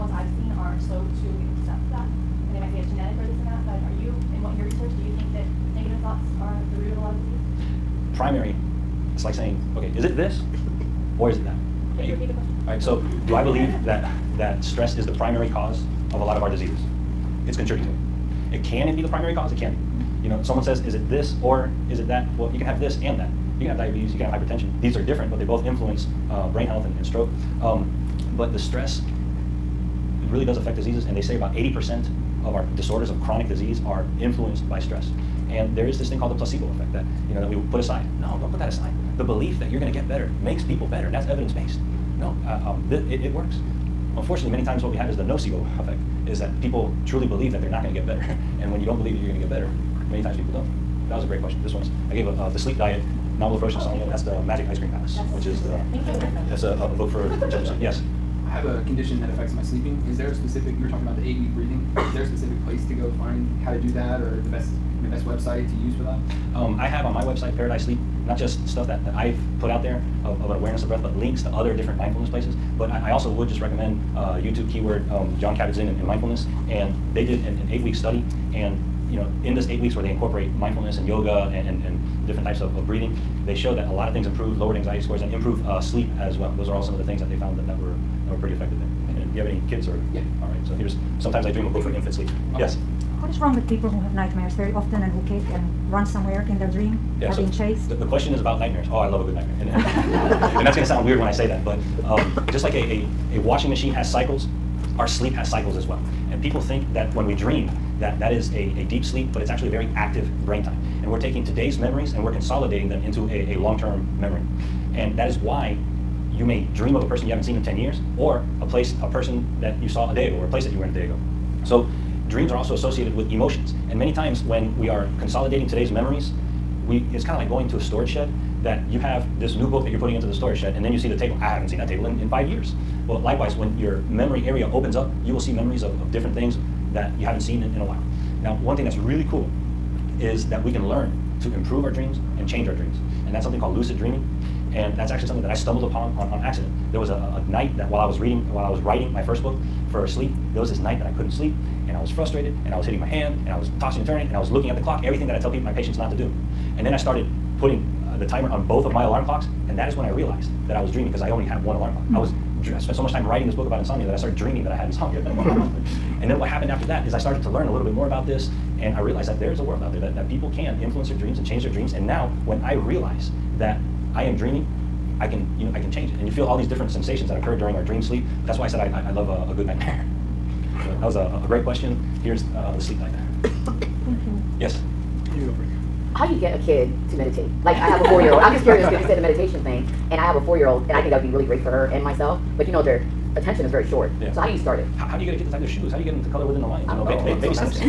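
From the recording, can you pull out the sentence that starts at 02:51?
And now when I realize that I am dreaming I can, you know, I can change it.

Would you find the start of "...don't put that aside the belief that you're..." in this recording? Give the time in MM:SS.
00:38.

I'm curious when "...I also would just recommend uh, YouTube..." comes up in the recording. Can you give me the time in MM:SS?
01:13.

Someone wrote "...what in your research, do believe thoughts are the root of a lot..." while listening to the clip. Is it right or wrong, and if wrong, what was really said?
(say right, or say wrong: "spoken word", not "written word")
wrong: "negative", not "believe".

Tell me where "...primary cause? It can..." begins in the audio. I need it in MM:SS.
00:19.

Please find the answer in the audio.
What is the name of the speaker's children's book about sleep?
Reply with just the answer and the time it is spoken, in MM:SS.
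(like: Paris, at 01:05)
The Magic Ice Cream Palace, at 00:54.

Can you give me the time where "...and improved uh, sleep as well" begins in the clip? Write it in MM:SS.
01:25.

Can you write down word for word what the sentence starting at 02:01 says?
So dreams are also associated with emotions.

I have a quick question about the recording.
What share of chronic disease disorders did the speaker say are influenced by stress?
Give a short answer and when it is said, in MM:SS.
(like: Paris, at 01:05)
80%, at 00:31.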